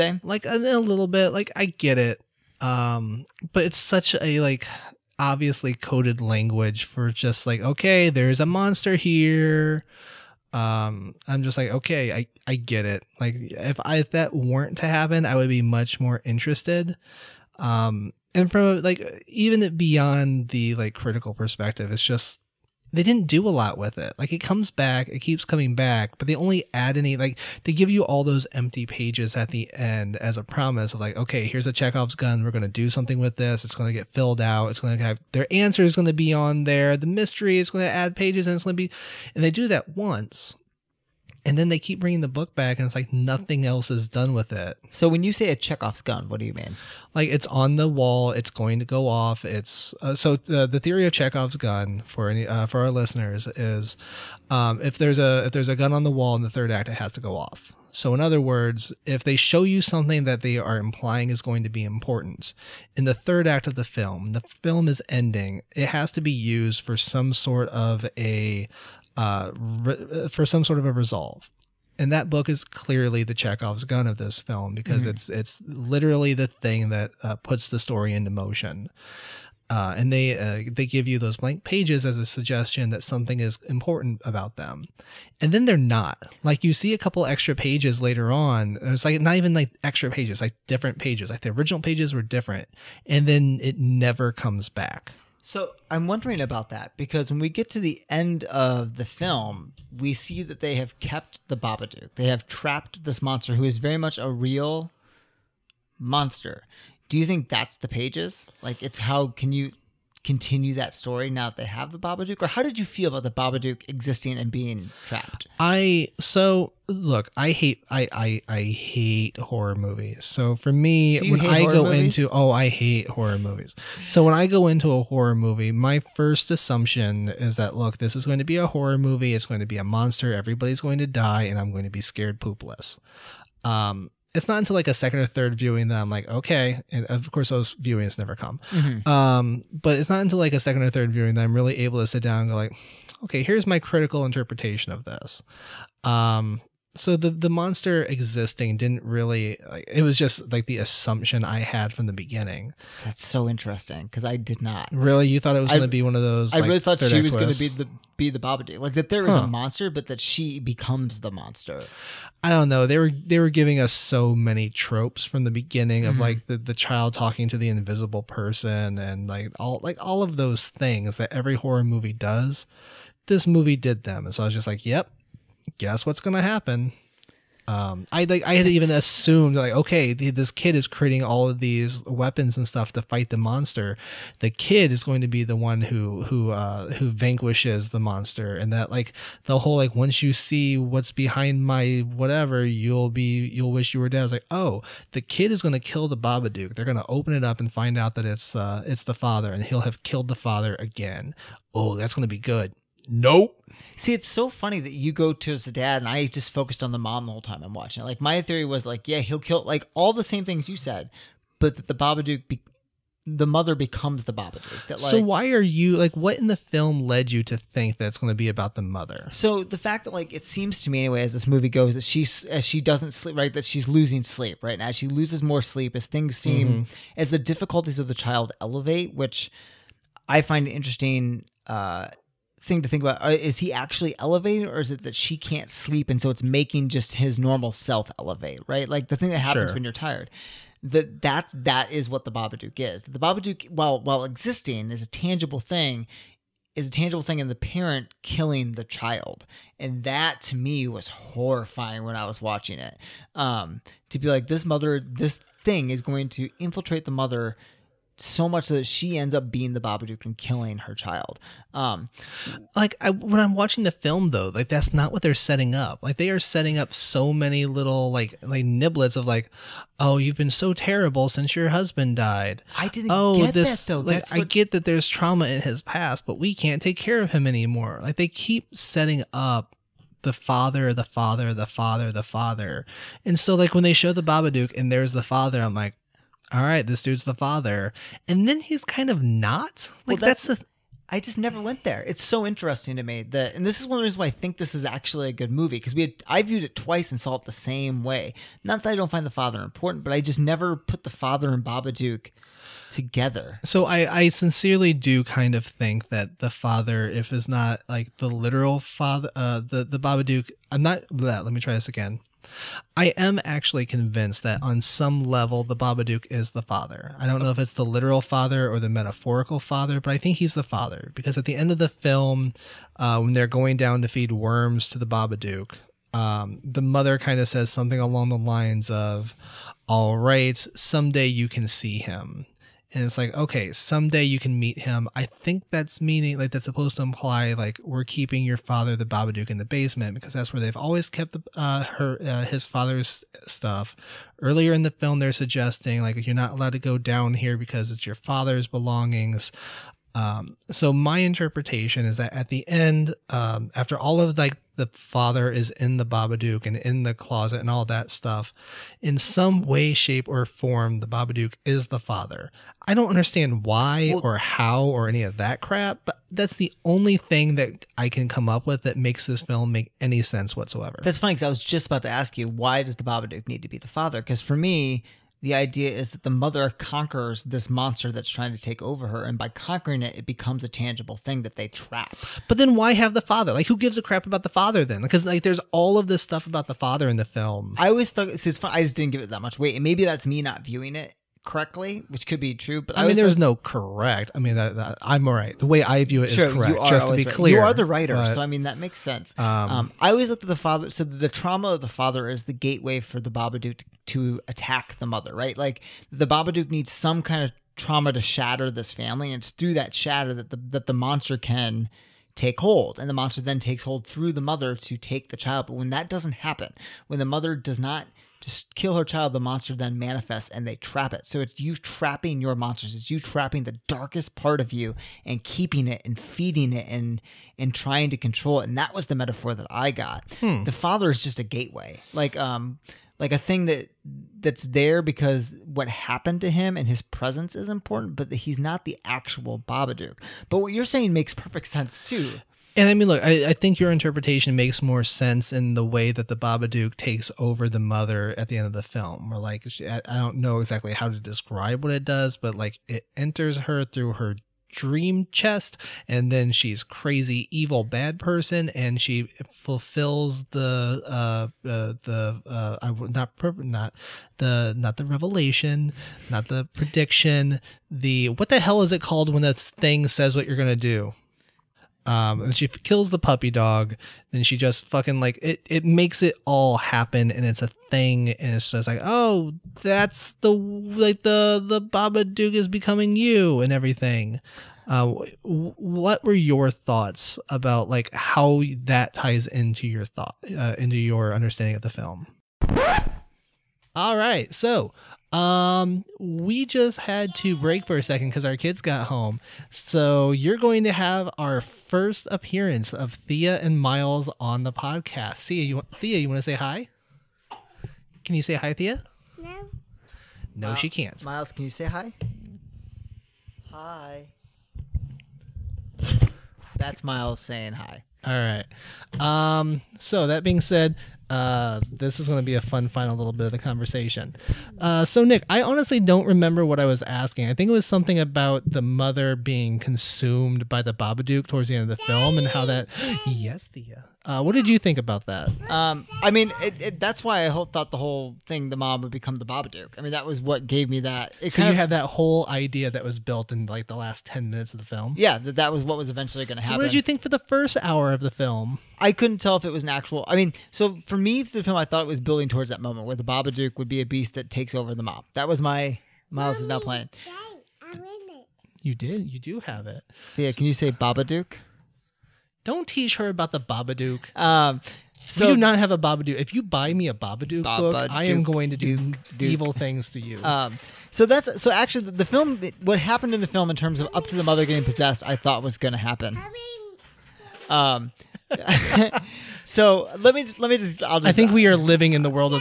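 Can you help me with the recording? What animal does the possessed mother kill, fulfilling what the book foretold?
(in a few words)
the puppy dog.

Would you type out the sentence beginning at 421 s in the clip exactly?
So it's you trapping your monsters.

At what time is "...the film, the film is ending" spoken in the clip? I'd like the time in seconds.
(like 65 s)
63 s.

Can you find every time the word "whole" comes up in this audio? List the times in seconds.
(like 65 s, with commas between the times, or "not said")
189 s, 207 s, 537 s, 542 s.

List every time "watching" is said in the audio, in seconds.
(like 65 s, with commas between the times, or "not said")
207 s, 252 s, 263 s.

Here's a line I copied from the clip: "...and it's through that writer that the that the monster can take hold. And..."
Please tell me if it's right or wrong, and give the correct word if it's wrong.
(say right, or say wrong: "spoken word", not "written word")
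wrong: "shatter", not "writer".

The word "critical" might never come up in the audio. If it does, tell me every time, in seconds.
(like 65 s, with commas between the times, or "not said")
20 s, 143 s.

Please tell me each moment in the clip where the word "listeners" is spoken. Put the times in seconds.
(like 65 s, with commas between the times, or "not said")
52 s.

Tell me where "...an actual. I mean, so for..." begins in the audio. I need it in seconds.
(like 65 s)
549 s.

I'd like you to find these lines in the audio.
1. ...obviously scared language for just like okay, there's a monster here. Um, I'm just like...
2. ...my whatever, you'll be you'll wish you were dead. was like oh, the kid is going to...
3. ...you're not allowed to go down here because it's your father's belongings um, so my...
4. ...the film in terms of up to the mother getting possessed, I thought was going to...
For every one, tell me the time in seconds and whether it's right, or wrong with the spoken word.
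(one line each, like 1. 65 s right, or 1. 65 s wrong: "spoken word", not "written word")
1. 5 s wrong: "coded", not "scared"
2. 191 s right
3. 346 s right
4. 573 s right.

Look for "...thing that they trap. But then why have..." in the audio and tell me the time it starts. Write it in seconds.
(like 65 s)
381 s.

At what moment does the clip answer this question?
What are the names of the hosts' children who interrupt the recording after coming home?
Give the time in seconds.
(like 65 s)
503 s.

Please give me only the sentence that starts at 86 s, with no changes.
Like you see a couple extra pages later on, it's like not even like extra pages, like different pages.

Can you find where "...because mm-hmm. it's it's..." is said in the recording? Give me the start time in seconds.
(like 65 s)
74 s.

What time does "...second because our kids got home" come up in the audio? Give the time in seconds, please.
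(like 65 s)
498 s.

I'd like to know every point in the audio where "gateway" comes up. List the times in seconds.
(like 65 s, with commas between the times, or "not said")
402 s, 431 s.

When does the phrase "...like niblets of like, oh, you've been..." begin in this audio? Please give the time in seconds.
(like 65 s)
268 s.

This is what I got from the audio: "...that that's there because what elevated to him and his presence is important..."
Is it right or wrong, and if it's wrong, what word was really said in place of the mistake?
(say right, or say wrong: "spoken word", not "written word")
wrong: "happened", not "elevated".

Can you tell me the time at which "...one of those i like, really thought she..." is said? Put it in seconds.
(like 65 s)
156 s.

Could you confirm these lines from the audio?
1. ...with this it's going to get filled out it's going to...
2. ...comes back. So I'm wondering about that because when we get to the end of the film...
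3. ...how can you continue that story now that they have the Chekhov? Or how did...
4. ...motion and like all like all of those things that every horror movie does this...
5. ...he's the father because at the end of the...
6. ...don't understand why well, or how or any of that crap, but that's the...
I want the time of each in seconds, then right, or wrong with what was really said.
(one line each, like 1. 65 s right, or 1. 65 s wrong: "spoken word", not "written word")
1. 33 s right
2. 94 s right
3. 108 s wrong: "Babadook", not "Chekhov"
4. 168 s wrong: "person", not "motion"
5. 320 s right
6. 362 s right.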